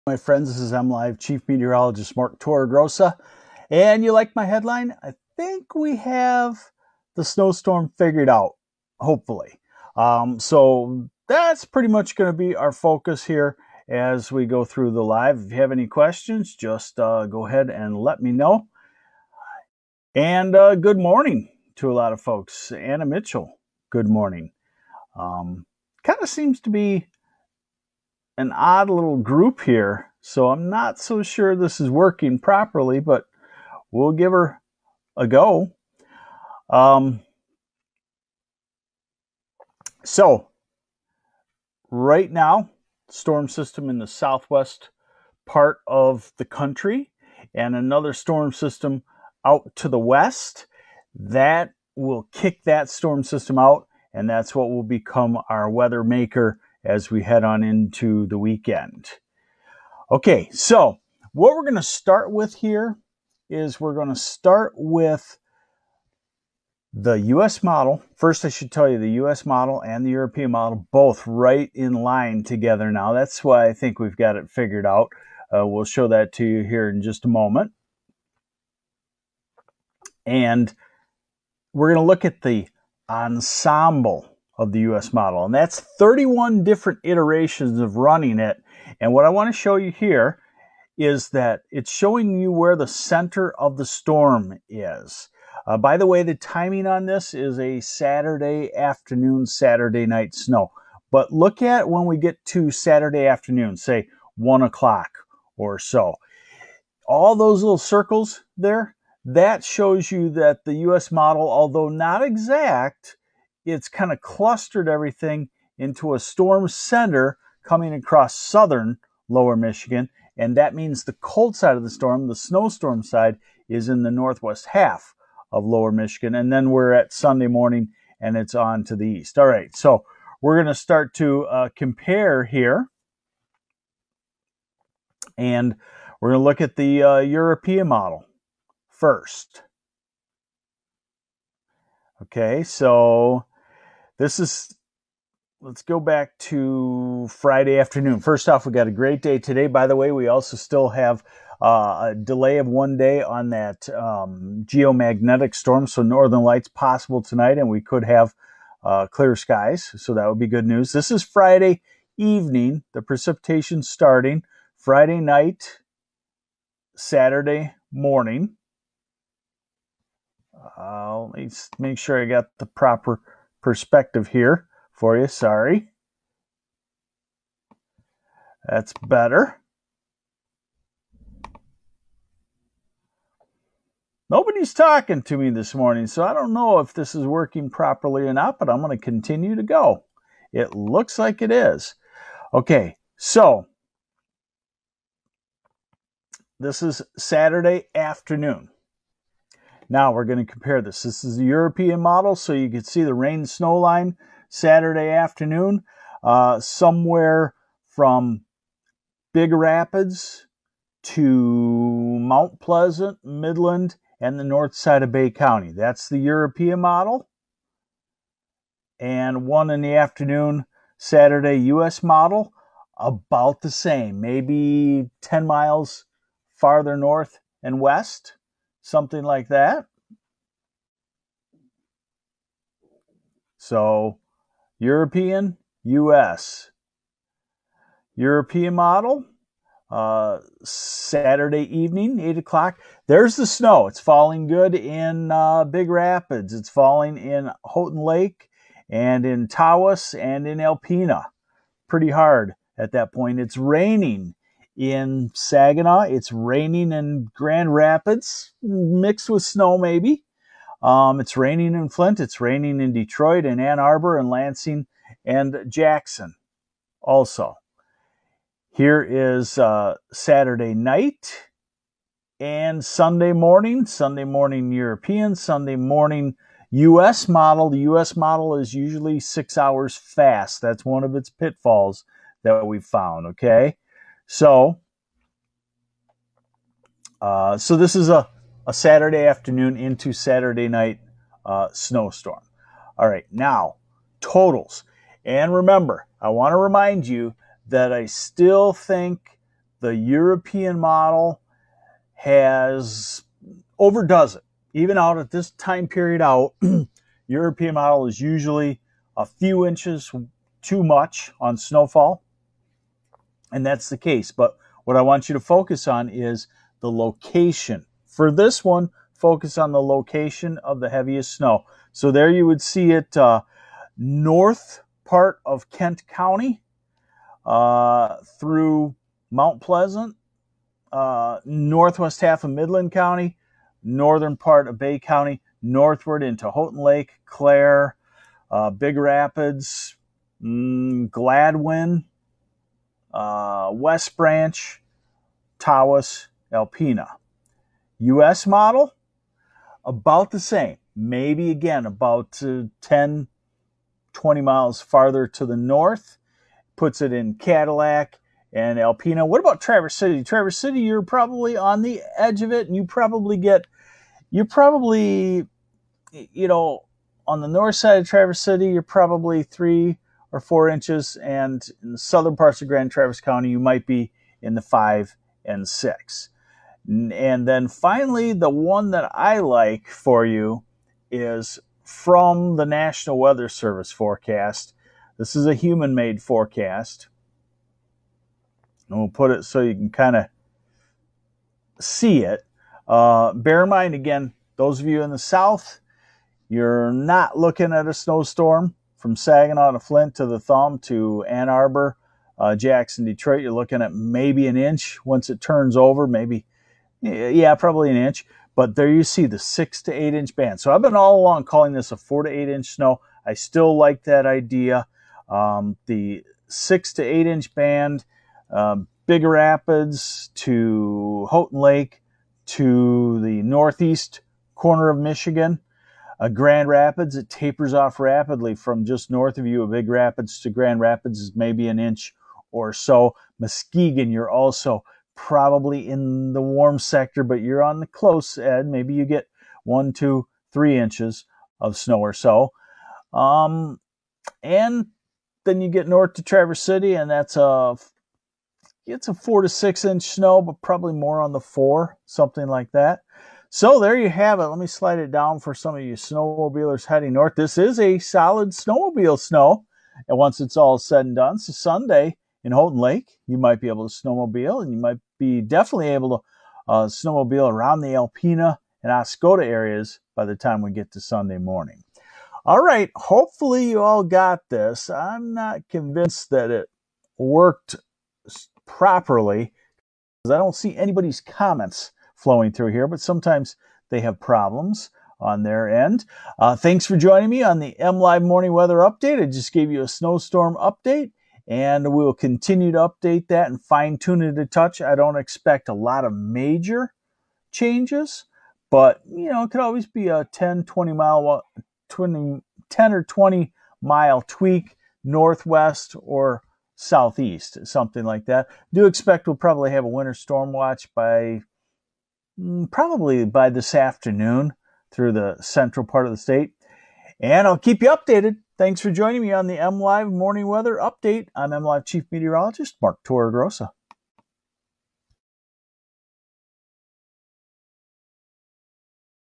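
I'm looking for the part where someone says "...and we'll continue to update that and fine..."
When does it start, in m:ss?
8:11.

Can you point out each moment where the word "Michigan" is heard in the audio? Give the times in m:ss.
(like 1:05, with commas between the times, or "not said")
1:59, 2:05, 7:04.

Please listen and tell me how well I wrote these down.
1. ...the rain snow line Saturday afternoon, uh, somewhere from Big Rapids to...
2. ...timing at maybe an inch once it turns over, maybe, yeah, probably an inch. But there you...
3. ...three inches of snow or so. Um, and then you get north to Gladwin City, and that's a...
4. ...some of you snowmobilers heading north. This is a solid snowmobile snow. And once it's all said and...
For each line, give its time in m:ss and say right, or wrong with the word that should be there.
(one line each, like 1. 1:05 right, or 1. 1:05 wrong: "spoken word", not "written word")
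1. 3:23 right
2. 6:43 wrong: "looking", not "timing"
3. 7:20 wrong: "Traverse", not "Gladwin"
4. 7:35 right.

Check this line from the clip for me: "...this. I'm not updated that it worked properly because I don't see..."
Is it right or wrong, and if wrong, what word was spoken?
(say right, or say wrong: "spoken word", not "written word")
wrong: "convinced", not "updated".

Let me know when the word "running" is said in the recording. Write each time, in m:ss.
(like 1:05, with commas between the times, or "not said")
1:27.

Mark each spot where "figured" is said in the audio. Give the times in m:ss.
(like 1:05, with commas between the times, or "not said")
0:07, 1:14.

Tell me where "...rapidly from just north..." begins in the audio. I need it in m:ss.
7:07.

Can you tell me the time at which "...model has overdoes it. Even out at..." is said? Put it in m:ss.
5:00.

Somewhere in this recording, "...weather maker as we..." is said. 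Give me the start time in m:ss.
0:55.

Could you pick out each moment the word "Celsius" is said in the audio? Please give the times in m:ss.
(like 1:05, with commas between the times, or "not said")
not said.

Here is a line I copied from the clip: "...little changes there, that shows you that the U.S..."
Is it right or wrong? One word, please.
wrong.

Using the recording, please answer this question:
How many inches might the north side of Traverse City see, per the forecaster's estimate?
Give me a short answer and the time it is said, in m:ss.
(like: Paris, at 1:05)
3 or 4, at 6:09.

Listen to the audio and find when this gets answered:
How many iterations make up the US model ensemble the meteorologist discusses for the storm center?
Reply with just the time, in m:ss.
1:25.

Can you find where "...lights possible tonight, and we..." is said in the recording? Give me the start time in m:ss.
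2:36.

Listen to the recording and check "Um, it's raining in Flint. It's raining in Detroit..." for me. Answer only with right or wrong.
right.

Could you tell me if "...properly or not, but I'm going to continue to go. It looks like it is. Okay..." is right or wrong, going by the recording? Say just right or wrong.
right.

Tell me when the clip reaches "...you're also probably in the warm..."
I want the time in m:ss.
7:14.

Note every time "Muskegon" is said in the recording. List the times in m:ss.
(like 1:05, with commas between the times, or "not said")
7:13.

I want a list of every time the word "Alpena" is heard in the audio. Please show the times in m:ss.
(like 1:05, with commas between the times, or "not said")
4:10, 5:46, 5:58, 7:47.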